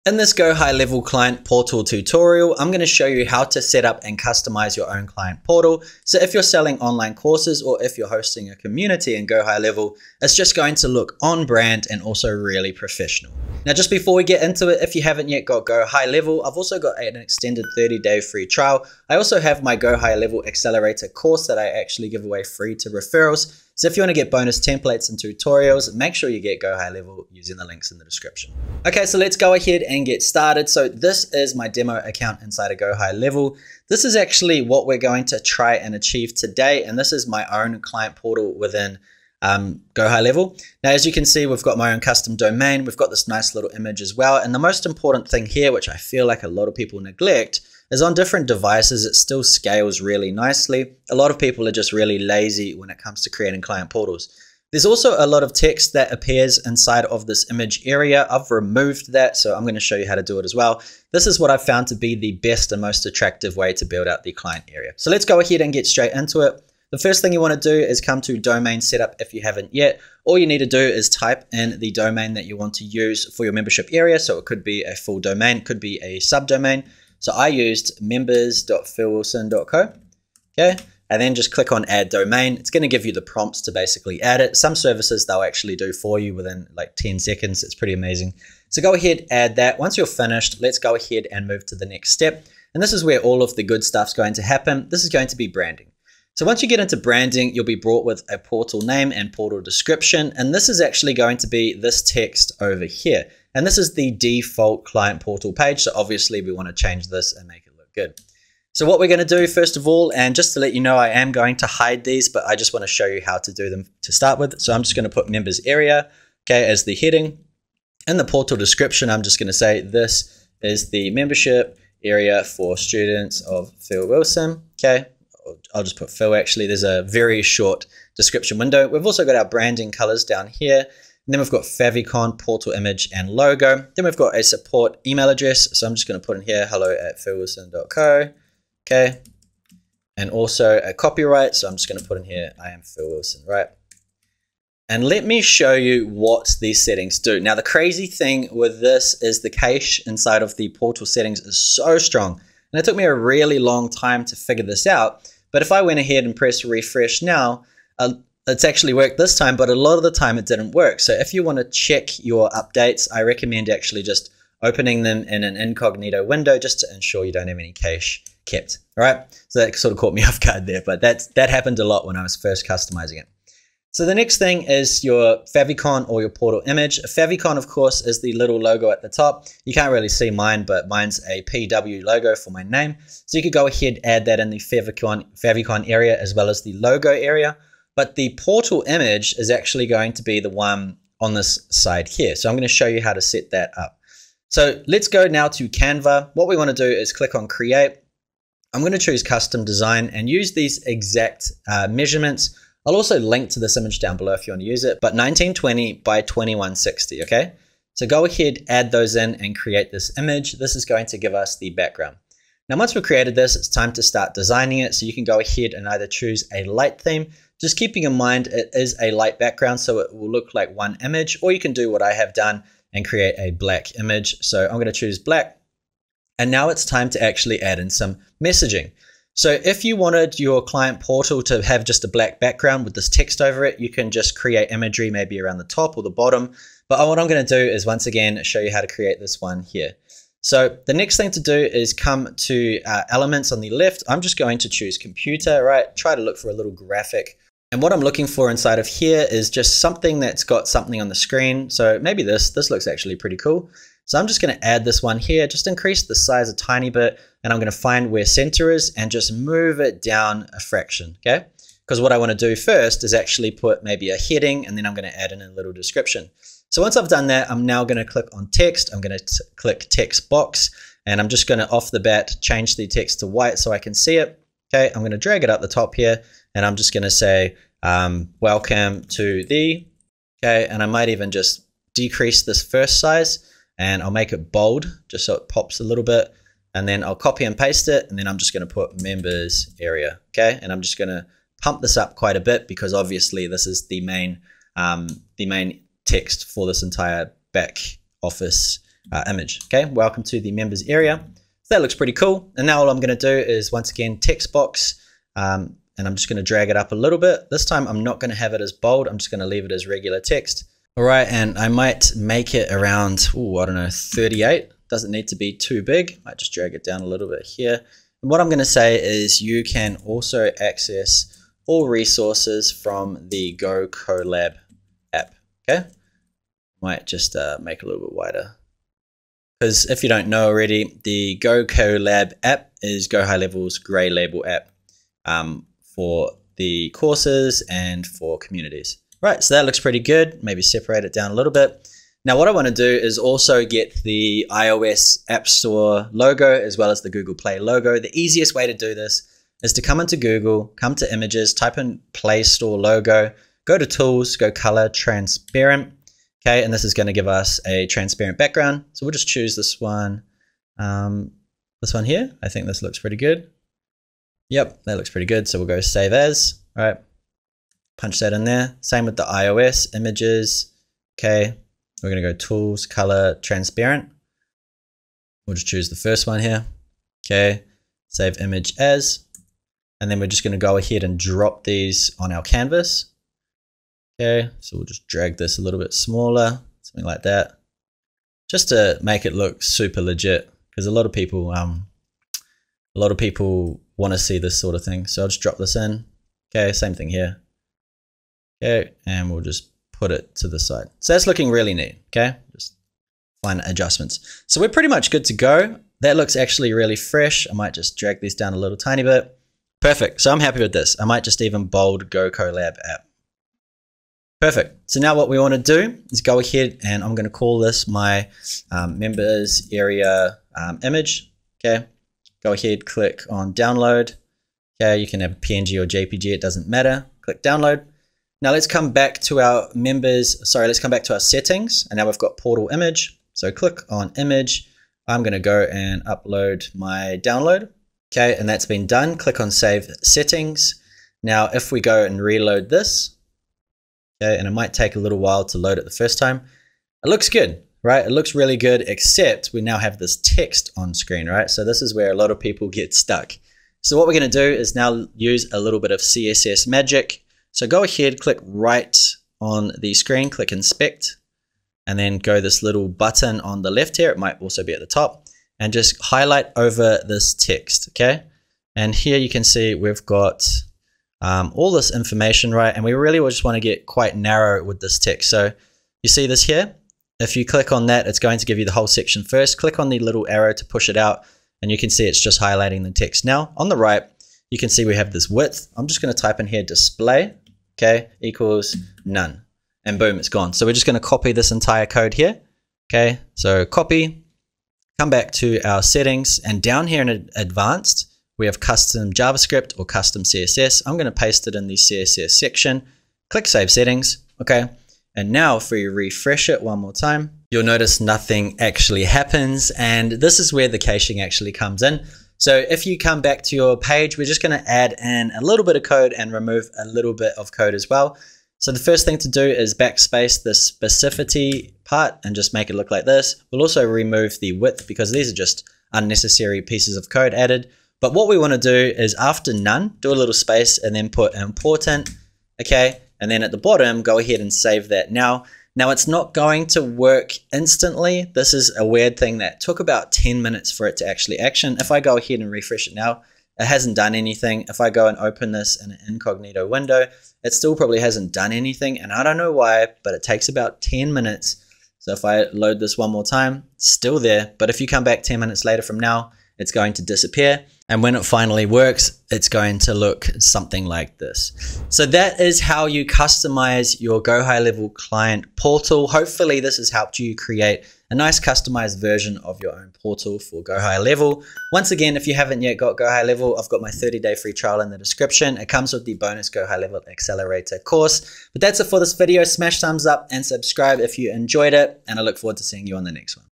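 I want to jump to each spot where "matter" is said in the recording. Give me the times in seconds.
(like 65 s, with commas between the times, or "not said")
426 s.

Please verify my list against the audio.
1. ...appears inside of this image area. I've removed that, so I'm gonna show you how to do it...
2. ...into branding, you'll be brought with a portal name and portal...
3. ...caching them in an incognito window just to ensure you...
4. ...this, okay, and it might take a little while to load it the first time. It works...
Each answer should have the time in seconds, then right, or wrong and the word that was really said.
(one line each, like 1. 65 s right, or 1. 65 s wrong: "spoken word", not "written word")
1. 56 s right
2. 96 s right
3. 164 s wrong: "opening", not "caching"
4. 442 s wrong: "looks", not "works".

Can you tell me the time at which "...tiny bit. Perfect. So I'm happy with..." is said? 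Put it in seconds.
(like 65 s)
408 s.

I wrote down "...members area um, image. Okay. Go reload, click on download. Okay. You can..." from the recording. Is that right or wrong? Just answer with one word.
wrong.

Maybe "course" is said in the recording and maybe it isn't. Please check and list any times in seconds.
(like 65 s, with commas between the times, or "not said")
7 s, 21 s, 177 s, 336 s, 577 s.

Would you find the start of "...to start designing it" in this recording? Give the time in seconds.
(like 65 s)
213 s.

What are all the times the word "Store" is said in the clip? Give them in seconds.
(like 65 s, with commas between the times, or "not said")
345 s, 352 s.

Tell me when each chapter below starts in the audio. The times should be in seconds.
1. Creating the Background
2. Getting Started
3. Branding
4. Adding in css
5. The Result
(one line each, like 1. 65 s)
1. 195 s
2. 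65 s
3. 97 s
4. 458 s
5. 30 s.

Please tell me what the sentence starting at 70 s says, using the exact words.
All you need to do is type in the domain that you want to use for your membership area.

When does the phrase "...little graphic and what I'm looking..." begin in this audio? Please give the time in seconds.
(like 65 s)
246 s.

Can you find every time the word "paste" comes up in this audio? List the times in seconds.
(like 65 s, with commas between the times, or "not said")
287 s, 501 s.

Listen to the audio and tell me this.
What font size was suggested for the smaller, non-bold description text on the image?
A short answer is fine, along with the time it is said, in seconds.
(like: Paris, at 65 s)
38, at 313 s.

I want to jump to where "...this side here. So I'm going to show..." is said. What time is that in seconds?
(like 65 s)
191 s.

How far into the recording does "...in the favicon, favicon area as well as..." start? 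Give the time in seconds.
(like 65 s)
184 s.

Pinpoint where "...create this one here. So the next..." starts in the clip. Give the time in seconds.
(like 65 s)
238 s.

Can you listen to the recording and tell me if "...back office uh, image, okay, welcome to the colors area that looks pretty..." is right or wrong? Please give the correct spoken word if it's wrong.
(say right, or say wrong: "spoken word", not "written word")
wrong: "members", not "colors".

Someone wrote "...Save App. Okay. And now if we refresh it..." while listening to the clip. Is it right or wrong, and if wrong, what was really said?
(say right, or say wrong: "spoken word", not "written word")
wrong: "Settings", not "App".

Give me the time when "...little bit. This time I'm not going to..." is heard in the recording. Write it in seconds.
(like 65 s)
306 s.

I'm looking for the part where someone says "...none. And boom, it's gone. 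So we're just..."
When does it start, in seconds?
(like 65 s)
489 s.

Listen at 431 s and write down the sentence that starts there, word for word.
And now we've got portal image.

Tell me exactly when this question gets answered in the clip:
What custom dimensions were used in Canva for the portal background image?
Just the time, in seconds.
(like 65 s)
205 s.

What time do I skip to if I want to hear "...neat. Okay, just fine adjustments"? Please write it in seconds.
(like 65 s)
401 s.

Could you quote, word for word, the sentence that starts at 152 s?
And it took me a really long time to figure this out.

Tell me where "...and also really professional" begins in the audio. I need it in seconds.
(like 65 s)
11 s.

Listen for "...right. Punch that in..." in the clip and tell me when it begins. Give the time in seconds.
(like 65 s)
366 s.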